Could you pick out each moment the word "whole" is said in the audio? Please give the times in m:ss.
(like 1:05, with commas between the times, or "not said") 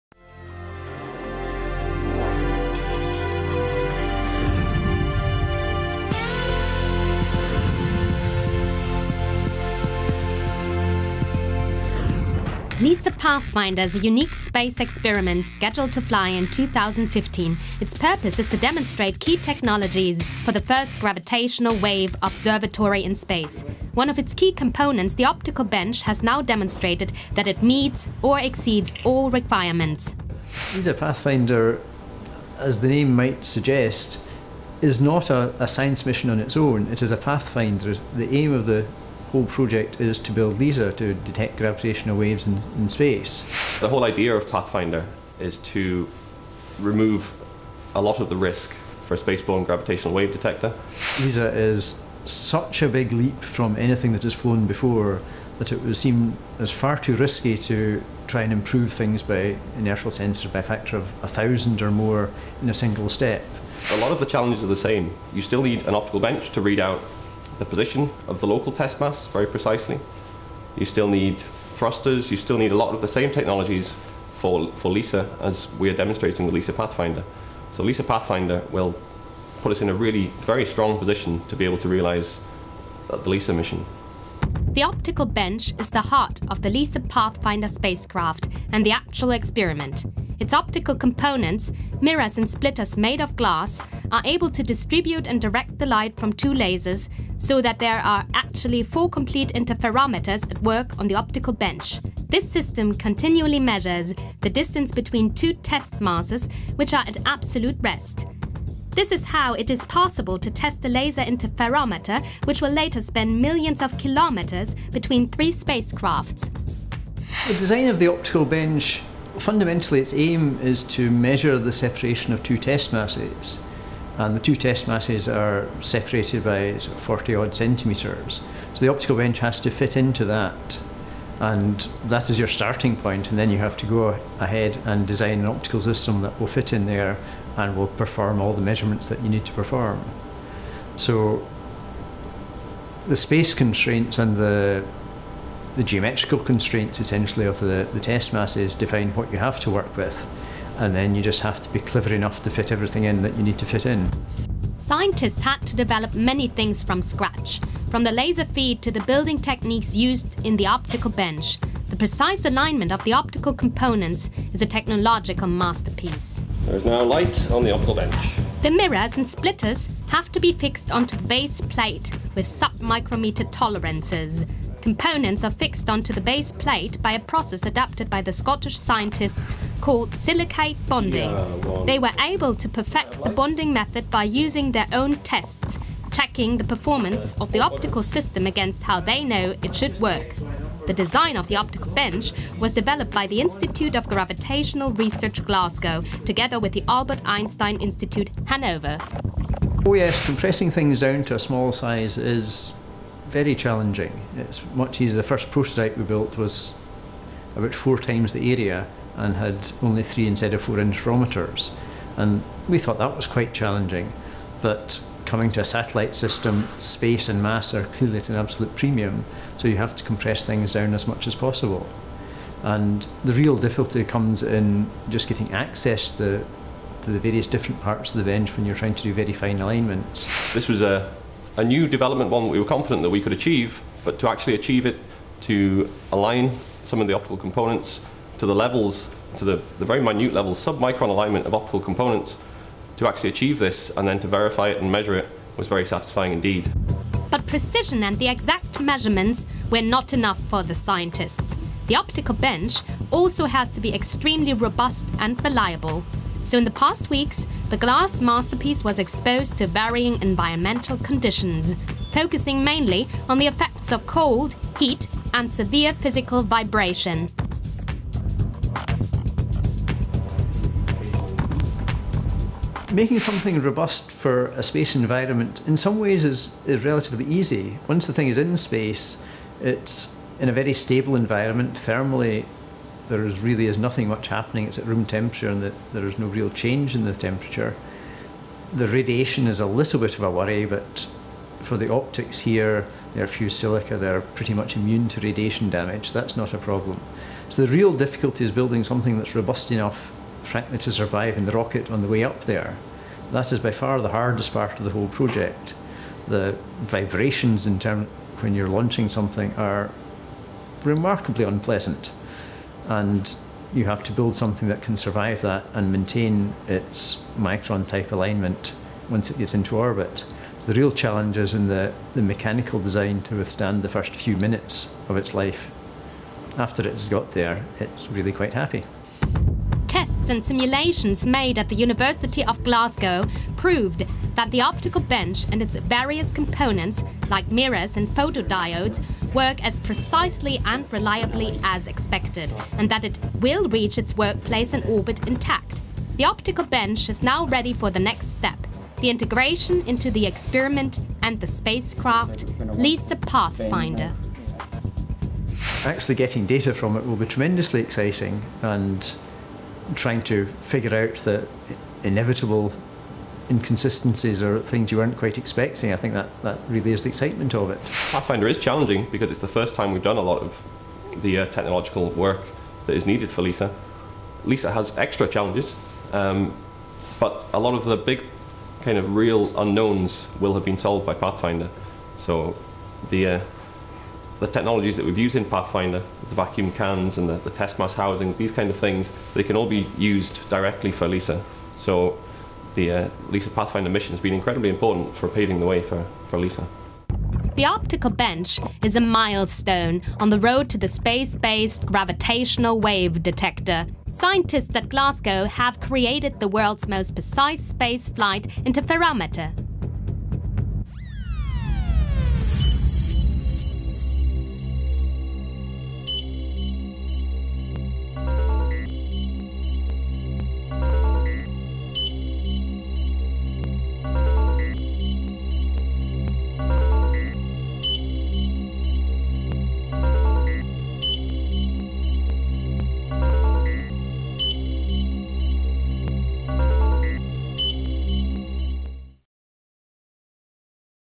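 0:39, 0:43, 5:04.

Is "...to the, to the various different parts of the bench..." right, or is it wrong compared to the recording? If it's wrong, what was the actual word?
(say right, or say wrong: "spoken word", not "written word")
right.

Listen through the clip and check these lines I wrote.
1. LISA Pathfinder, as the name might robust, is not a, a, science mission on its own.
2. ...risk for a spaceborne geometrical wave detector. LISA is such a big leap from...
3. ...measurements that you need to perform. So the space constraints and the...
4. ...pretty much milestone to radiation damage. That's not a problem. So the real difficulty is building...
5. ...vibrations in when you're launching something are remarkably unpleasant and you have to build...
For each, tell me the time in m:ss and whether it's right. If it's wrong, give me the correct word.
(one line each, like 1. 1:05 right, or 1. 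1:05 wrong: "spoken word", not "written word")
1. 0:30 wrong: "suggest", not "robust"
2. 0:48 wrong: "gravitational", not "geometrical"
3. 2:18 right
4. 4:54 wrong: "immune", not "milestone"
5. 5:06 right.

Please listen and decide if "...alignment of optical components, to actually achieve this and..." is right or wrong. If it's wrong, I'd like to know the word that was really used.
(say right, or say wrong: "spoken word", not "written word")
right.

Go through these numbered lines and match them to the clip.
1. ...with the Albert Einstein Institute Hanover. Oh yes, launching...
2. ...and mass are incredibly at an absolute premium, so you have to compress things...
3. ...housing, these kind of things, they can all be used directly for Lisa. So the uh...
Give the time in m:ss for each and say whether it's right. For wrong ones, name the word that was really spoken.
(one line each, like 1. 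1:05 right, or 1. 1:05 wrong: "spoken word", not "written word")
1. 3:16 wrong: "compressing", not "launching"
2. 3:37 wrong: "clearly", not "incredibly"
3. 6:27 right.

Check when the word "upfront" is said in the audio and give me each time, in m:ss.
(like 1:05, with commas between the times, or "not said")
not said.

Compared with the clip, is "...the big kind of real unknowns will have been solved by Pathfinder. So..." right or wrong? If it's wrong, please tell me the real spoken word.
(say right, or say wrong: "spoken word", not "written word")
right.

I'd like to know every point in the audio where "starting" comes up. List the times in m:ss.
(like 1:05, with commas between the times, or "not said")
2:12.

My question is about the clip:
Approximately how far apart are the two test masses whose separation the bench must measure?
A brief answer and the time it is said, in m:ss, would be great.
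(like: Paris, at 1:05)
40 centimetres, at 2:06.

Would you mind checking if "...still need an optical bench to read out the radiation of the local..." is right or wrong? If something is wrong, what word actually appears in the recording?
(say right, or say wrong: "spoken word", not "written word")
wrong: "position", not "radiation".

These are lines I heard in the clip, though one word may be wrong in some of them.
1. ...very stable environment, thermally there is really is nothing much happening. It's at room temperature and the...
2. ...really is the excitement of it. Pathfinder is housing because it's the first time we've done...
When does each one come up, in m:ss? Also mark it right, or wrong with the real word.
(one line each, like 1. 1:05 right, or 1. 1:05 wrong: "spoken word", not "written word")
1. 4:40 right
2. 6:06 wrong: "challenging", not "housing".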